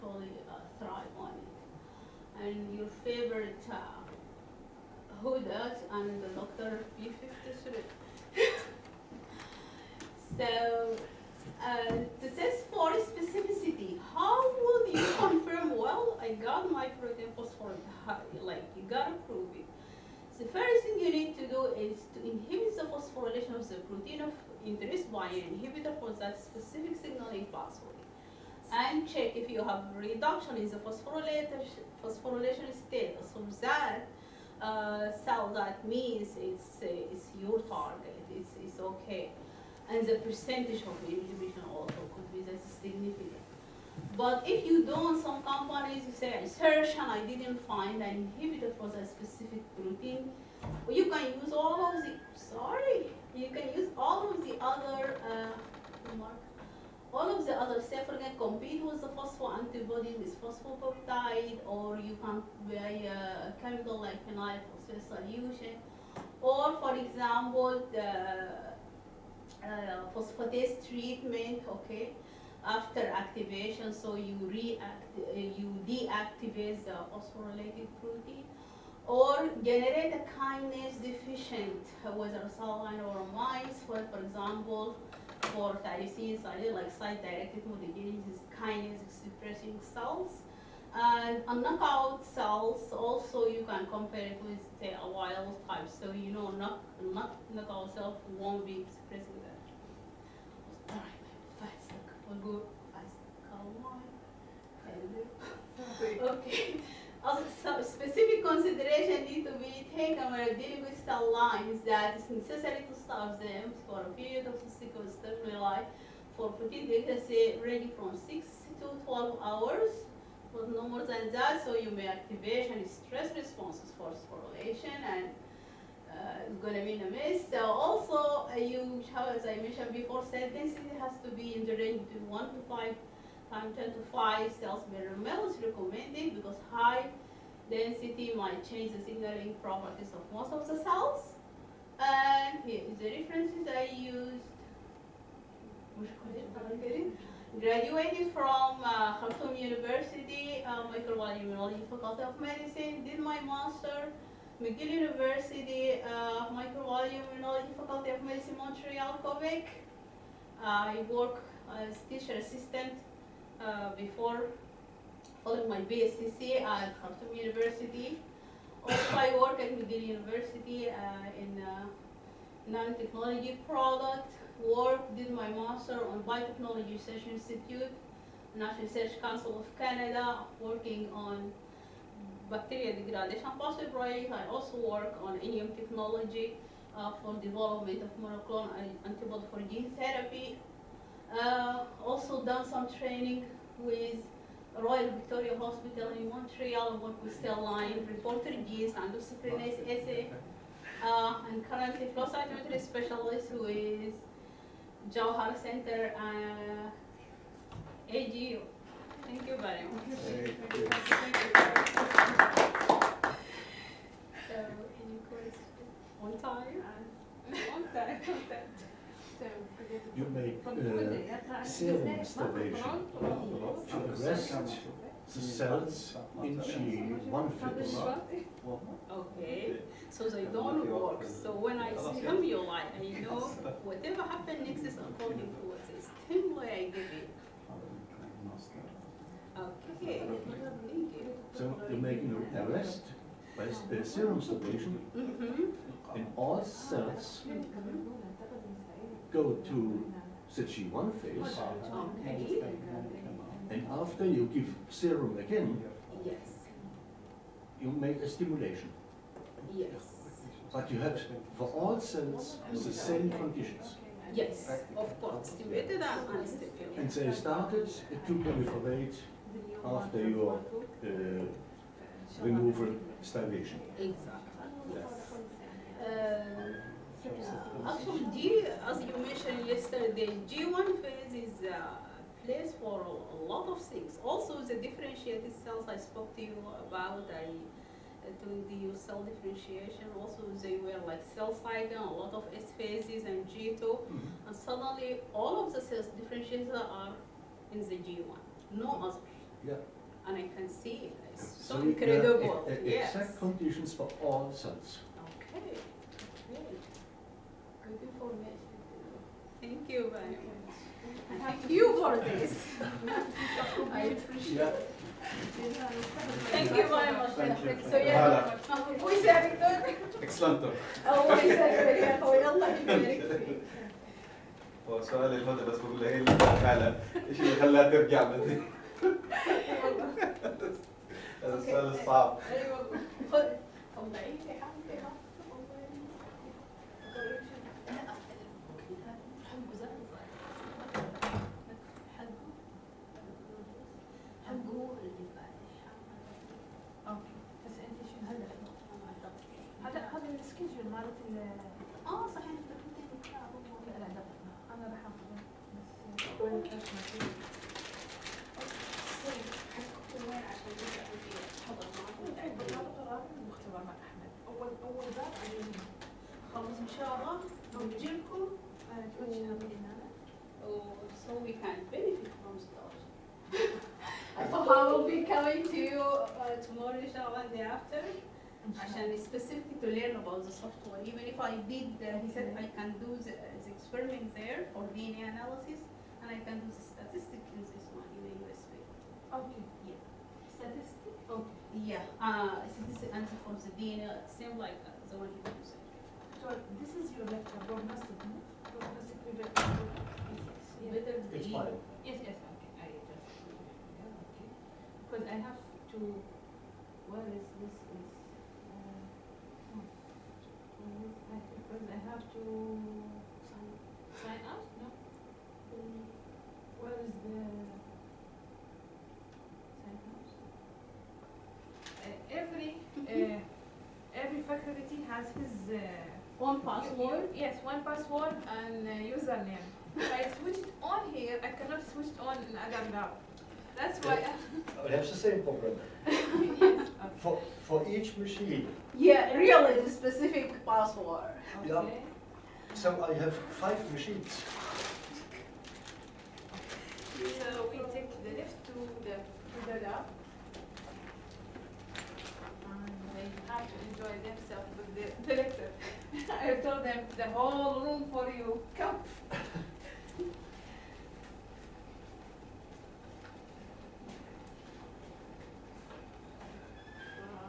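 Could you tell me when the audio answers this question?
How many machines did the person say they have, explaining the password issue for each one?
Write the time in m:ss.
7:23.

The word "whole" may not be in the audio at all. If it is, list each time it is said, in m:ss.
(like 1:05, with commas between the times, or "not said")
7:37.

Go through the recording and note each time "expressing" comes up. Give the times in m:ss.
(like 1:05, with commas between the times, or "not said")
1:29, 1:38.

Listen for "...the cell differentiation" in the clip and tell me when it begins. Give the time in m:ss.
4:48.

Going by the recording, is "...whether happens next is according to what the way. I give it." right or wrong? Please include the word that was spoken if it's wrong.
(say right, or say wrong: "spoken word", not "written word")
wrong: "whatever", not "whether".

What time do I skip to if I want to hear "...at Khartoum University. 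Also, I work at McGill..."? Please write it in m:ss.
2:46.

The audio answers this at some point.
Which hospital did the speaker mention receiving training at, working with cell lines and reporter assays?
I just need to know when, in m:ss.
3:14.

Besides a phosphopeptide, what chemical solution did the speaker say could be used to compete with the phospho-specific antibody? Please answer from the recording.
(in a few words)
phenyl phosphate.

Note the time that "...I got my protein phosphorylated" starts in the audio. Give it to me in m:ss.
0:16.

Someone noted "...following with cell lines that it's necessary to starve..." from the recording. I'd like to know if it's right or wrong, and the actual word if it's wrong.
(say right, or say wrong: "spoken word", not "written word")
wrong: "dealing", not "following".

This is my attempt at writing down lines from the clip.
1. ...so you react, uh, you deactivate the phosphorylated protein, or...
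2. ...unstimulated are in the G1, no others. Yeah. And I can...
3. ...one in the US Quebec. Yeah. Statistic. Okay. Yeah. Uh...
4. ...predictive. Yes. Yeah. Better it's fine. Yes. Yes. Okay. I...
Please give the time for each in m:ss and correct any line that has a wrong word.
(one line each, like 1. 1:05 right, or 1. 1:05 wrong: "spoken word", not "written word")
1. 1:13 right
2. 4:56 wrong: "differentiated", not "unstimulated"
3. 6:27 wrong: "Okay", not "Quebec"
4. 6:39 right.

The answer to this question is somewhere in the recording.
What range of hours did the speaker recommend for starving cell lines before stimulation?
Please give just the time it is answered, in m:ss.
1:58.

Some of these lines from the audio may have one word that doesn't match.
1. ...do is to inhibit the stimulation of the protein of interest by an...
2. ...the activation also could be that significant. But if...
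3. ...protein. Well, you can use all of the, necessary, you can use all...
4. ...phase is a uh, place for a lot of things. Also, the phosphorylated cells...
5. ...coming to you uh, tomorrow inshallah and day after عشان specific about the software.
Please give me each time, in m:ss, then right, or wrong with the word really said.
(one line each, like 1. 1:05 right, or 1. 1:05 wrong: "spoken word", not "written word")
1. 0:21 wrong: "phosphorylation", not "stimulation"
2. 0:41 wrong: "inhibition", not "activation"
3. 0:49 wrong: "sorry", not "necessary"
4. 4:41 wrong: "differentiated", not "phosphorylated"
5. 6:15 right.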